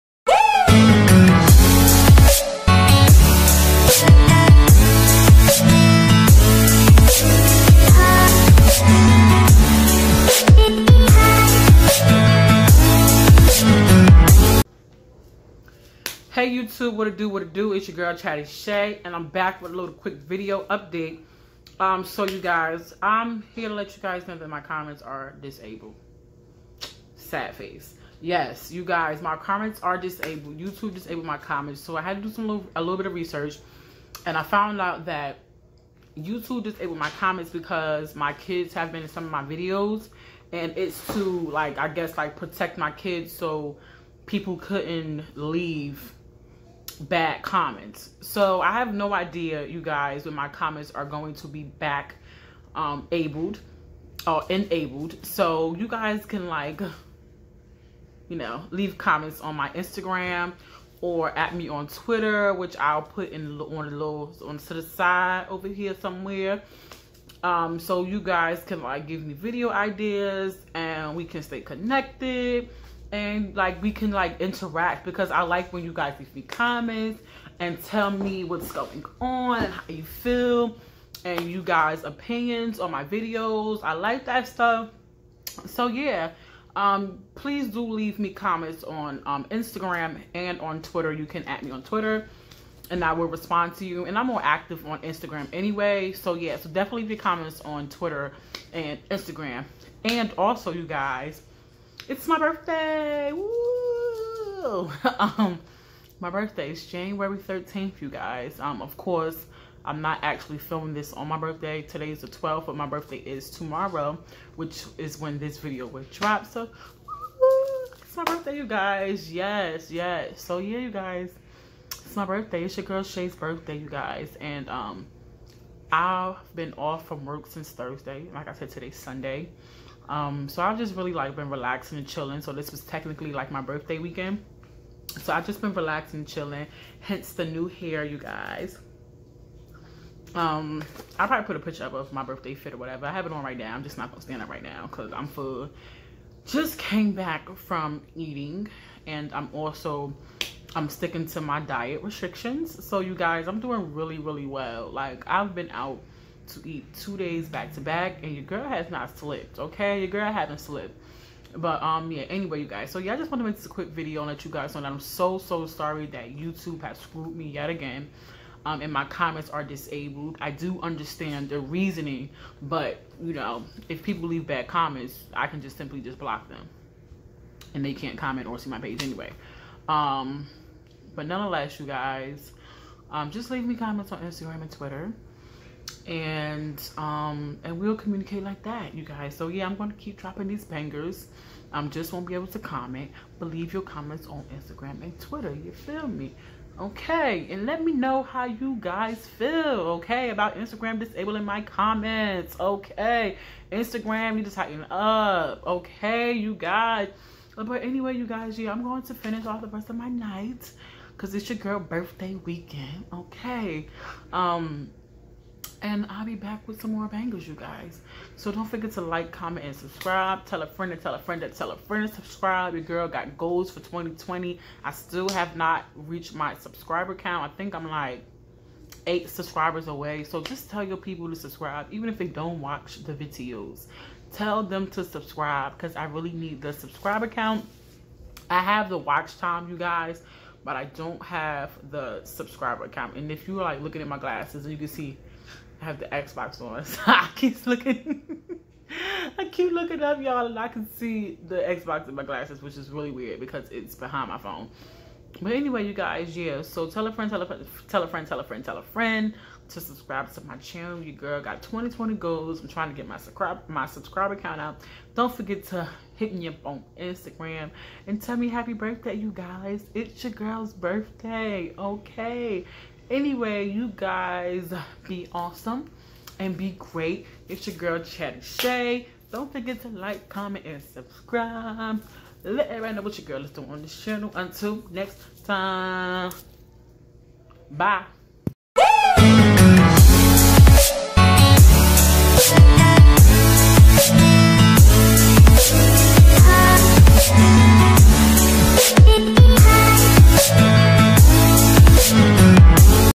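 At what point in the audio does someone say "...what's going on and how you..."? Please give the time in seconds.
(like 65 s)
78 s.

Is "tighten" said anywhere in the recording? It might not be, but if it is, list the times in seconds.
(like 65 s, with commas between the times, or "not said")
204 s.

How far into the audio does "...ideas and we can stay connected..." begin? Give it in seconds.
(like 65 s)
69 s.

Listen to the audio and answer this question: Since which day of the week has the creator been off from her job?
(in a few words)
Thursday.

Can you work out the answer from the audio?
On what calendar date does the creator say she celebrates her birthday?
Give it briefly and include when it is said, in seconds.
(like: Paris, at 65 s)
January 13th, at 106 s.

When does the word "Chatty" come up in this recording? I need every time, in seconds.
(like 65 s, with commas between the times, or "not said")
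18 s, 277 s.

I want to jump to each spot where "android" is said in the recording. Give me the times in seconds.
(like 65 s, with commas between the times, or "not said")
not said.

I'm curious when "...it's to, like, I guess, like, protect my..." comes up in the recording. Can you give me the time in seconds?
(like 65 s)
40 s.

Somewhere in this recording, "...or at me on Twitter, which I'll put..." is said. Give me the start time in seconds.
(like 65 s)
61 s.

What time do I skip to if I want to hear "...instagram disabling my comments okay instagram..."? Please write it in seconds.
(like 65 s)
200 s.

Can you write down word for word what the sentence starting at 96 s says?
So yeah, so definitely leave your comments on Twitter and Instagram.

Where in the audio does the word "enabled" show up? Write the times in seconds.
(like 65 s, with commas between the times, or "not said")
54 s.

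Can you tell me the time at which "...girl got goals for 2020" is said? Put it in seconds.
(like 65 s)
222 s.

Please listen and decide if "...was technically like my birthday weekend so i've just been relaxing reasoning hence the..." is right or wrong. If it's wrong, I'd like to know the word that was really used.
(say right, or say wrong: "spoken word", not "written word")
wrong: "chilling", not "reasoning".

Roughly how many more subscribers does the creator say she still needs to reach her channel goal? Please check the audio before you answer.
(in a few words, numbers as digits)
8.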